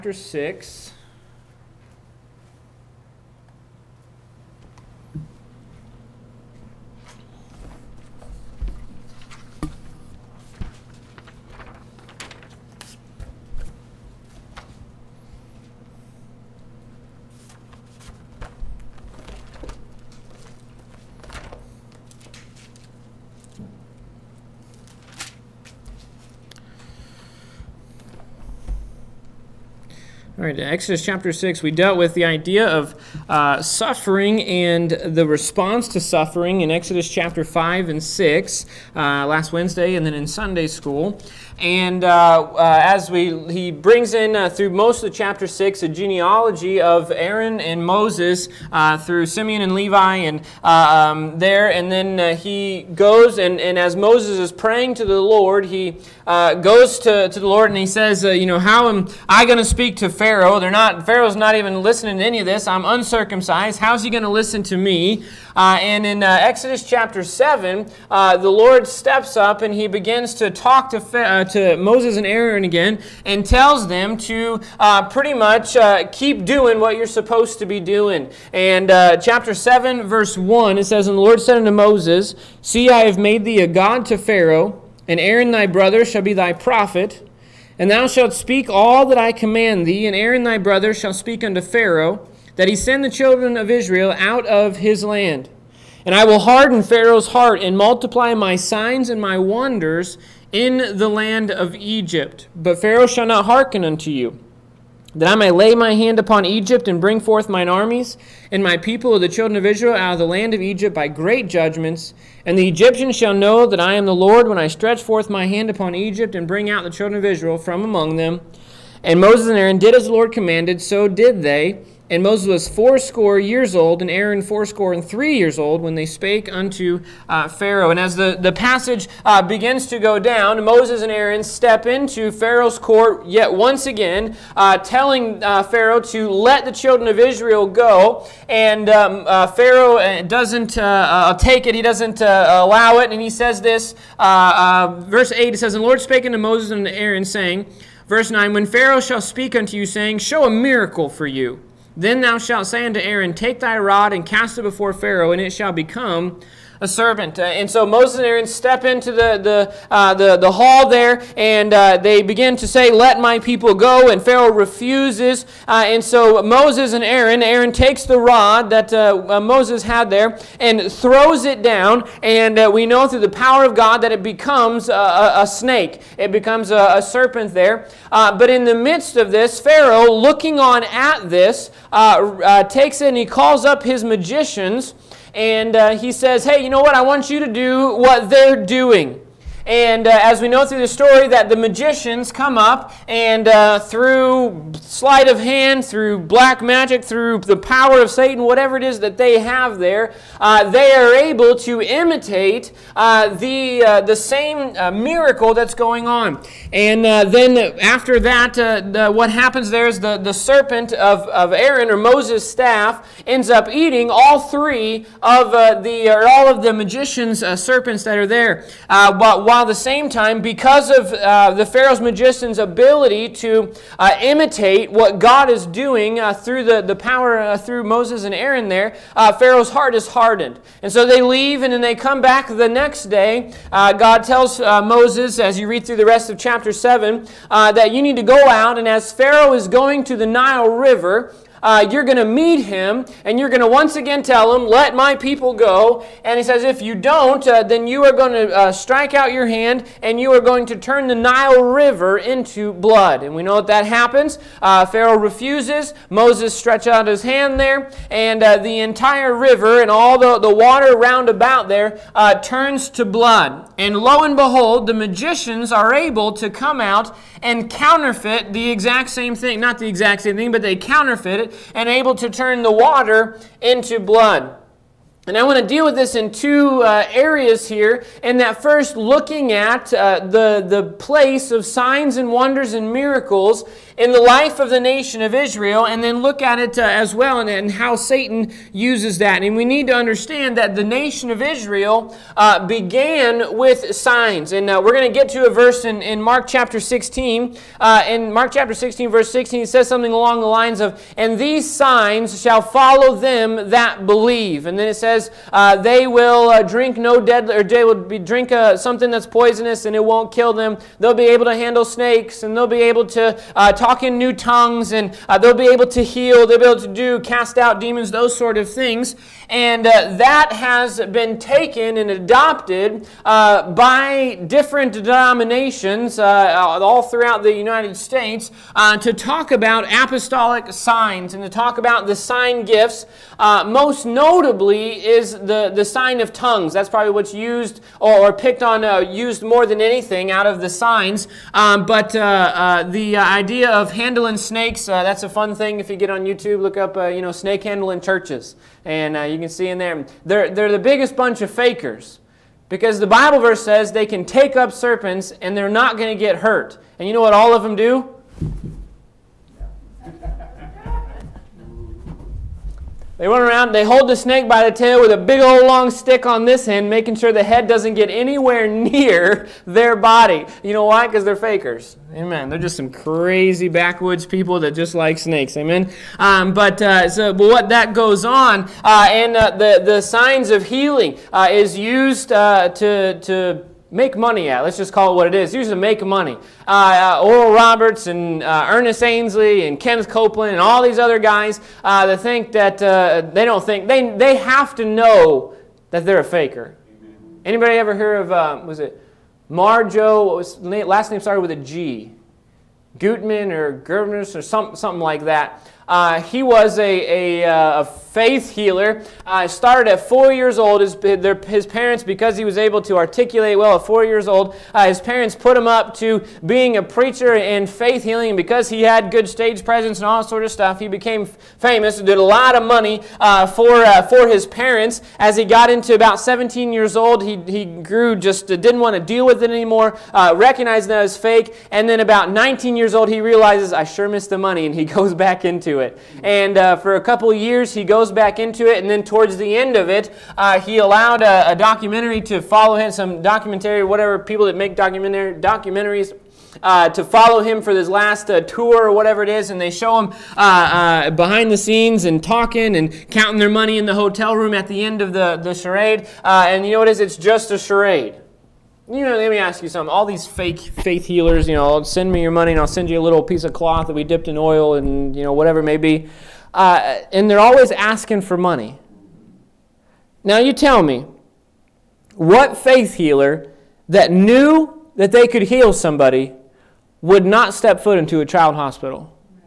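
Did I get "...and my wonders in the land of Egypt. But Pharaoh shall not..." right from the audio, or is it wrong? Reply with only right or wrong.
right.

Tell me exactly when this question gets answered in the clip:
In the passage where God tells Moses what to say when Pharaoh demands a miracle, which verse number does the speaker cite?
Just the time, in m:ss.
2:28.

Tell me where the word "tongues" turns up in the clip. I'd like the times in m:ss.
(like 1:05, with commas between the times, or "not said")
5:14, 5:36.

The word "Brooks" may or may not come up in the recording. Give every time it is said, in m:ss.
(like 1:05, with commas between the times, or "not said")
not said.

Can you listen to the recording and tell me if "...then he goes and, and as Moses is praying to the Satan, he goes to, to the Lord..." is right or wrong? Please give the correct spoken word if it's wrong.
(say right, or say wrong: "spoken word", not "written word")
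wrong: "Lord", not "Satan".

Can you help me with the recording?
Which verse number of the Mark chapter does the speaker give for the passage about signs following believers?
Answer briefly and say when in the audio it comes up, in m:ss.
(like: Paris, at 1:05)
Verse 16, at 4:59.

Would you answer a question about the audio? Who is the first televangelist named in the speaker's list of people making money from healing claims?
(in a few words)
Oral Roberts.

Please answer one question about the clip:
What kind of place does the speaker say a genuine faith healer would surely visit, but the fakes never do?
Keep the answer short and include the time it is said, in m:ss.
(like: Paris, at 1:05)
Child hospital, at 7:58.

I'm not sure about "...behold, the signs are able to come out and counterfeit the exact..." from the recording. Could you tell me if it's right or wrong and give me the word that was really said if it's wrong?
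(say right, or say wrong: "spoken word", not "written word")
wrong: "magicians", not "signs".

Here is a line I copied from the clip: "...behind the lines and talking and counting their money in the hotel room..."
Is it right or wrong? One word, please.
wrong.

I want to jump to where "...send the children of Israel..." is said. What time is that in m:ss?
1:32.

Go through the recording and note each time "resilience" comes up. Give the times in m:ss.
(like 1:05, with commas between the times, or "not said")
not said.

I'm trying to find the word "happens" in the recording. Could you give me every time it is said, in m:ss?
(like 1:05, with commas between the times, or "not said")
3:29, 4:13.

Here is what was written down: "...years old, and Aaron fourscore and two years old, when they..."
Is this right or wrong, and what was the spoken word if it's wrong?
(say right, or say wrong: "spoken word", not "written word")
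wrong: "three", not "two".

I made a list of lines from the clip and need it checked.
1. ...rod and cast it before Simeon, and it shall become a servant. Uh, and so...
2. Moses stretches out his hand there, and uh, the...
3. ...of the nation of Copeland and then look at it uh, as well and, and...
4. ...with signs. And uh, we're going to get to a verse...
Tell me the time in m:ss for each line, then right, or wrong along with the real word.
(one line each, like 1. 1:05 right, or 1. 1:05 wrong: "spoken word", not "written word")
1. 2:33 wrong: "Pharaoh", not "Simeon"
2. 4:16 right
3. 4:44 wrong: "Israel", not "Copeland"
4. 4:53 right.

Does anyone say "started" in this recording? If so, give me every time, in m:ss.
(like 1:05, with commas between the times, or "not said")
6:41, 6:49.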